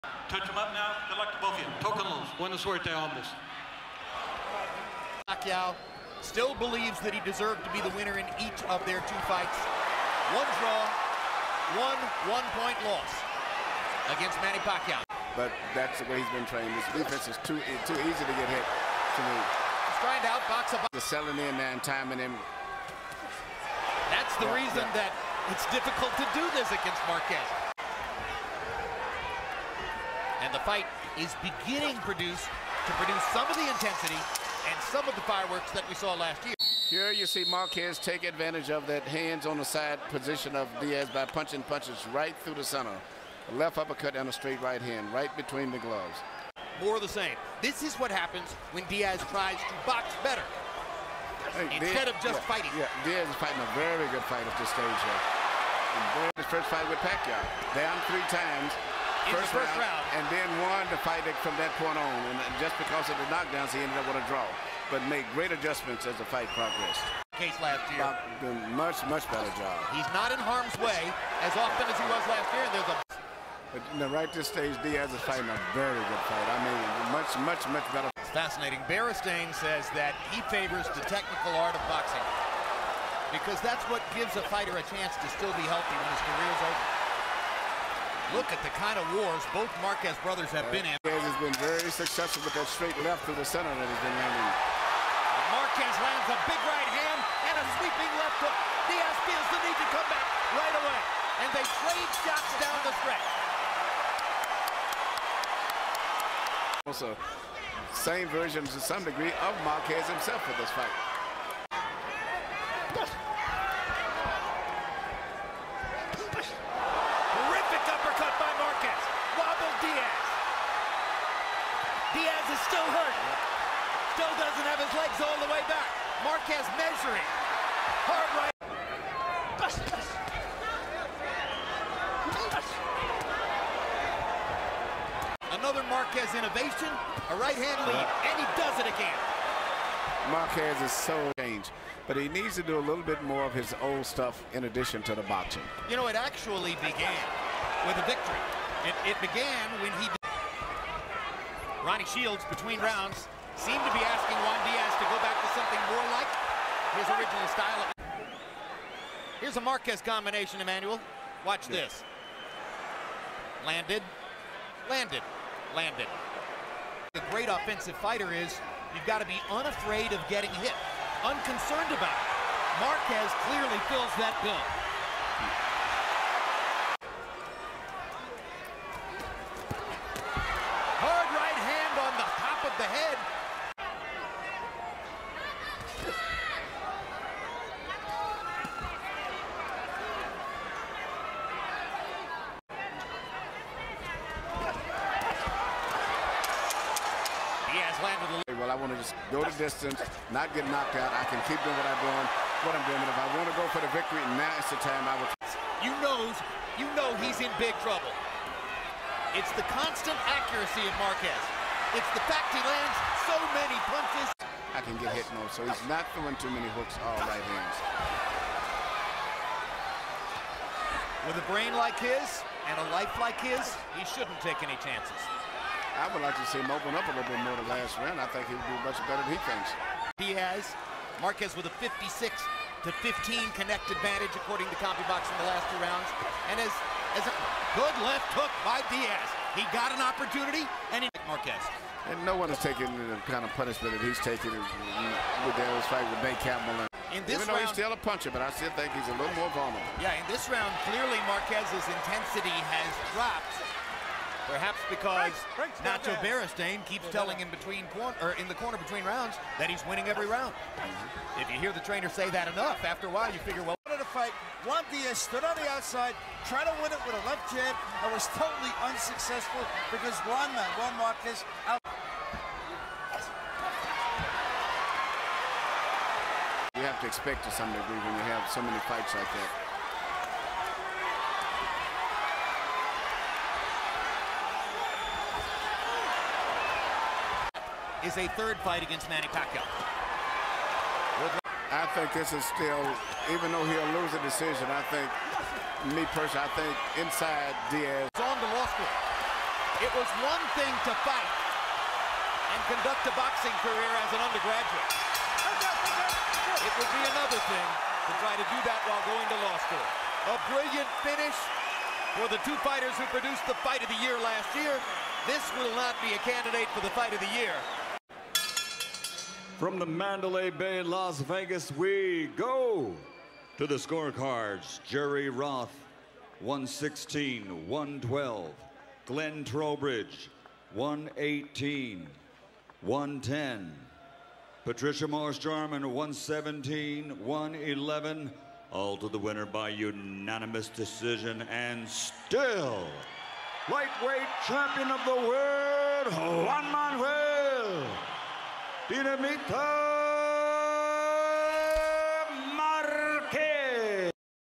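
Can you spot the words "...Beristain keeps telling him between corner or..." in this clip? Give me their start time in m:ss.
4:16.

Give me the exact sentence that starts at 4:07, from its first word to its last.
In this Even though round, he's still a puncher, but I still think he's a little more vulnerable.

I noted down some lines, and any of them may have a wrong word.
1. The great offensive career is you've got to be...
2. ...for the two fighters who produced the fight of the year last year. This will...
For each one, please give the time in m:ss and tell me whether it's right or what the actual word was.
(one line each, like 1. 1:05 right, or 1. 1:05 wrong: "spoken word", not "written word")
1. 2:47 wrong: "fighter", not "career"
2. 5:12 right.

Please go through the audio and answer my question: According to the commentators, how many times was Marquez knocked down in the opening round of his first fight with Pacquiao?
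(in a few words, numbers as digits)
3.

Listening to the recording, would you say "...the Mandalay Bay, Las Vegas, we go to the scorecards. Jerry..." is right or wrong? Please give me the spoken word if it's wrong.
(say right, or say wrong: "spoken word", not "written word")
right.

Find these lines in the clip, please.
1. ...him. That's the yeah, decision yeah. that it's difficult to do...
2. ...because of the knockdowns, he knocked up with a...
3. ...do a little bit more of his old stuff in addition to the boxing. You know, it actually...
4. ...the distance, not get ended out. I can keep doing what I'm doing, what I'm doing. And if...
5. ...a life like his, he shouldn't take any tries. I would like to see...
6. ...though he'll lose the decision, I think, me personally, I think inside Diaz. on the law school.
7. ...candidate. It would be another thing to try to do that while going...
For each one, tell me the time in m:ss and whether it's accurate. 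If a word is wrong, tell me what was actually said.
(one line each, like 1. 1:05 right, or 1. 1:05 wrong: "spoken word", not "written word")
1. 0:22 wrong: "reason", not "decision"
2. 1:02 wrong: "ended", not "knocked"
3. 2:22 right
4. 3:19 wrong: "knocked", not "ended"
5. 3:42 wrong: "chances", not "tries"
6. 4:53 right
7. 5:04 wrong: "undergraduate", not "candidate".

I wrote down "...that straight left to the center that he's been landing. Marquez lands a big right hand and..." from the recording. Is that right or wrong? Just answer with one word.
right.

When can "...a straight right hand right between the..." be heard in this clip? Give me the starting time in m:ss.
0:44.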